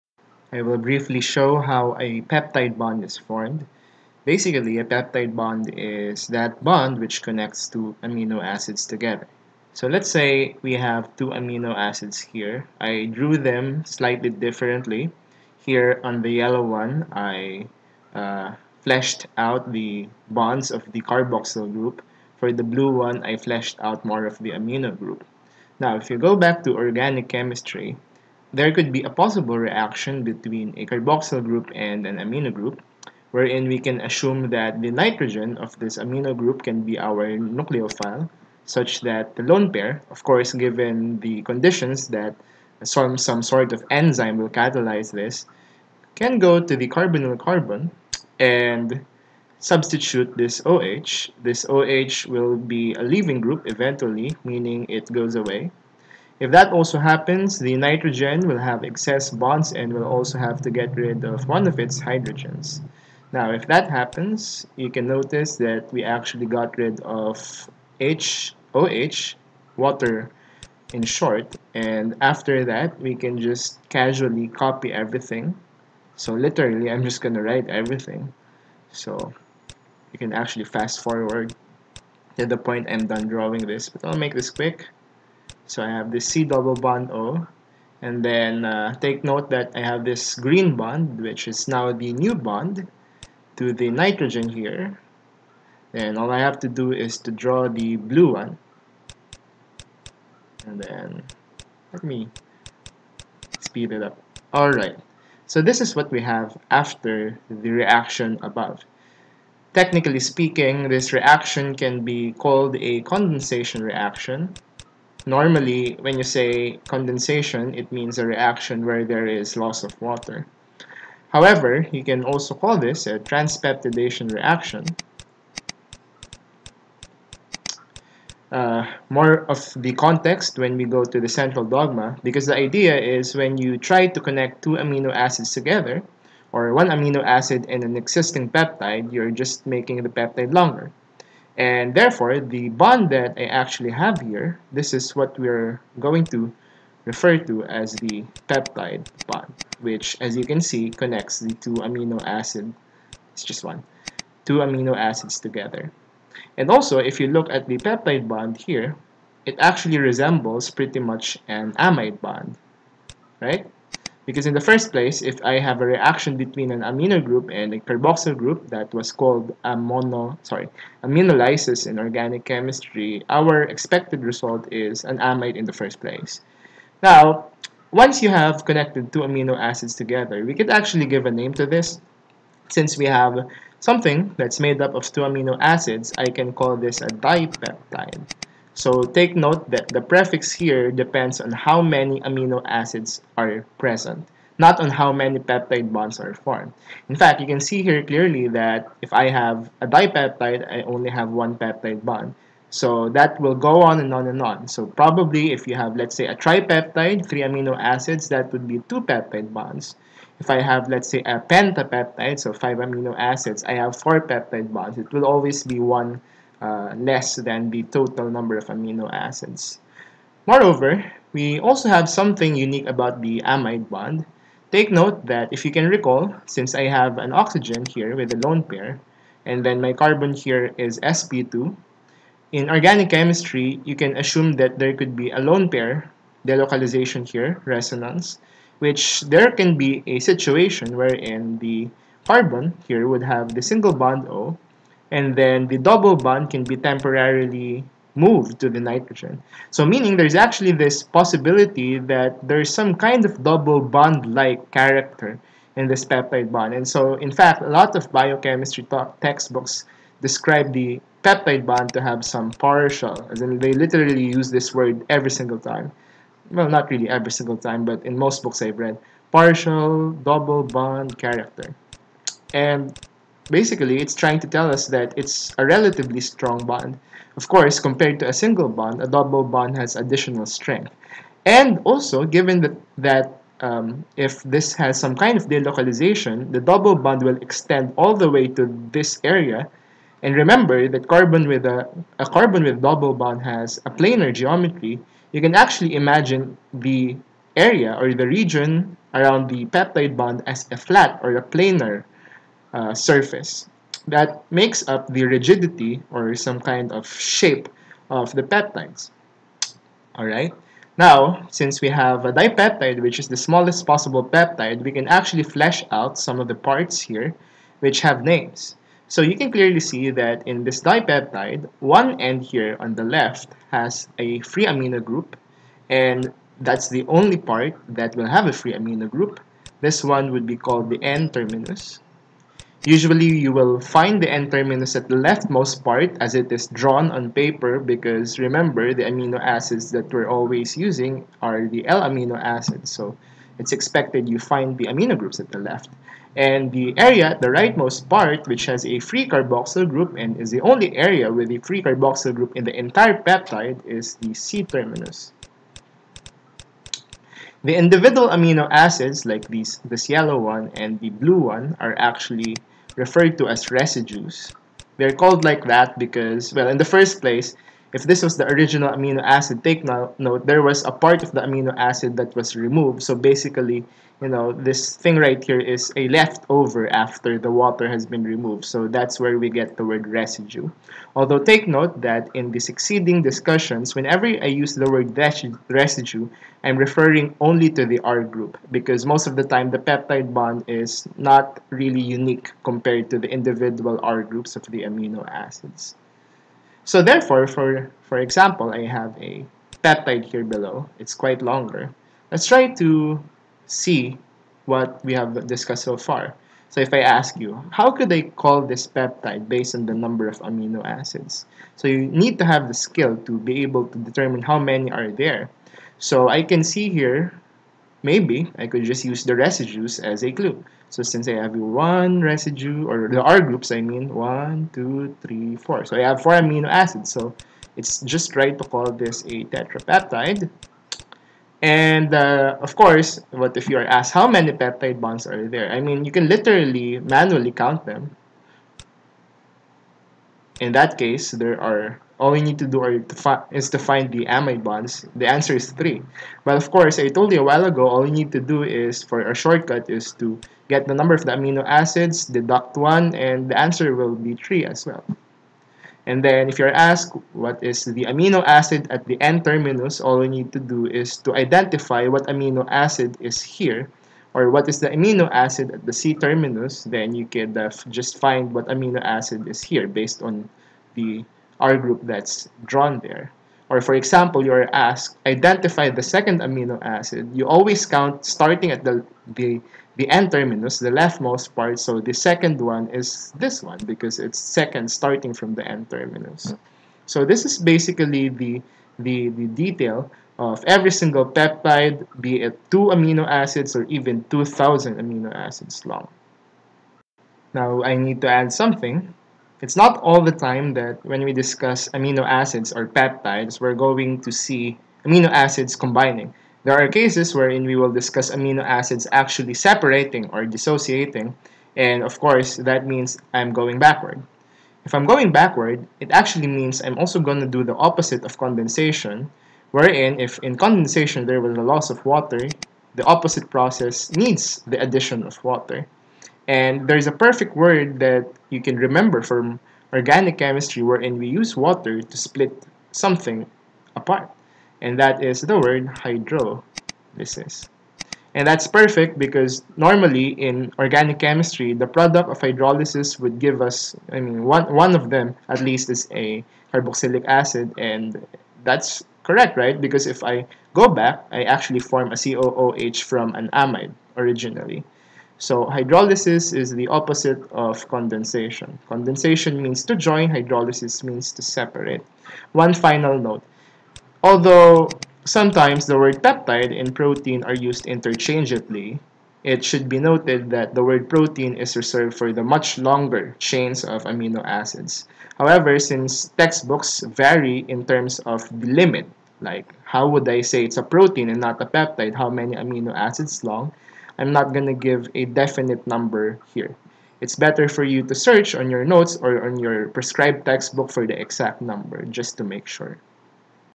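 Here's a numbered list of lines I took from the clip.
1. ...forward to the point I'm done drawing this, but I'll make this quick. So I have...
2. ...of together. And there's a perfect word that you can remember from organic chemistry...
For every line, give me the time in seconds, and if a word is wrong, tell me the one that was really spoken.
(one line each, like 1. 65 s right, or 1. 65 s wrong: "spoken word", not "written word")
1. 81 s right
2. 525 s wrong: "water", not "together".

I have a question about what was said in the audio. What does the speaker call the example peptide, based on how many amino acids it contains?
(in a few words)
Tetrapeptide.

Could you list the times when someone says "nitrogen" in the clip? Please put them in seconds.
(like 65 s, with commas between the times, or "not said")
34 s, 57 s, 93 s, 248 s.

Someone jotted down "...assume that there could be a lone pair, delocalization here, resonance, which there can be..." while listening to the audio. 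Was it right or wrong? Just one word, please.
right.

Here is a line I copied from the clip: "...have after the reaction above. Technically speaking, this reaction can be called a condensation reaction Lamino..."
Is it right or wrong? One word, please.
wrong.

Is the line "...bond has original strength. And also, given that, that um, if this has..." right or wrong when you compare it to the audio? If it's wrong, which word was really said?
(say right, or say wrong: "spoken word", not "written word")
wrong: "additional", not "original".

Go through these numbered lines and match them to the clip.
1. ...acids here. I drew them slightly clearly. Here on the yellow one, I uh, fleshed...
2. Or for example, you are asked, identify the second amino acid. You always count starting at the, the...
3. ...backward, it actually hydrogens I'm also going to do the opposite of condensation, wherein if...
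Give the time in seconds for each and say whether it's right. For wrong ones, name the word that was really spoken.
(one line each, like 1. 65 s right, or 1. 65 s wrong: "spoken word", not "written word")
1. 11 s wrong: "differently", not "clearly"
2. 473 s right
3. 515 s wrong: "means", not "hydrogens".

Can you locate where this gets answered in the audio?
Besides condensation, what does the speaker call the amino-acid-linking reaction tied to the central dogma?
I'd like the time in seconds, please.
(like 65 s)
123 s.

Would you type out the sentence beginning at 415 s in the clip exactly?
So I can see here maybe I could just use the residues as a clue.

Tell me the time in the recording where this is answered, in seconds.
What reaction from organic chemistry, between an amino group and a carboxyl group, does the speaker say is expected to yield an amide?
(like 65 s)
171 s.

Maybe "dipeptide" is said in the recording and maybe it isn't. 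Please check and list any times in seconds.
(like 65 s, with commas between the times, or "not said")
187 s, 199 s, 312 s, 320 s.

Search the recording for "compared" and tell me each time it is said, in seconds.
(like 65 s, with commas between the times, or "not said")
277 s, 392 s.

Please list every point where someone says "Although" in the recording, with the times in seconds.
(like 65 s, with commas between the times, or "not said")
381 s, 564 s.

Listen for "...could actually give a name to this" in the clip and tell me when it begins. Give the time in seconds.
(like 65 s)
180 s.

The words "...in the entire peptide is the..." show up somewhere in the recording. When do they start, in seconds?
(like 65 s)
352 s.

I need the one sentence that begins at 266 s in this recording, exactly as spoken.
Well, not really every single time, but in most books I've read, partial double bond character.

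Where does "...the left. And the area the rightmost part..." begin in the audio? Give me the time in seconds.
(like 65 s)
345 s.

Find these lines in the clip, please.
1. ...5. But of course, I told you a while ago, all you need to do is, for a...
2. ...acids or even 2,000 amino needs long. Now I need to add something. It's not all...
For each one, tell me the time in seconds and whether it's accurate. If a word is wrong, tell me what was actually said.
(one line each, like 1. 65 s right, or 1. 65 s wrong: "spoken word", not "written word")
1. 445 s wrong: "3", not "5"
2. 493 s wrong: "acids", not "needs".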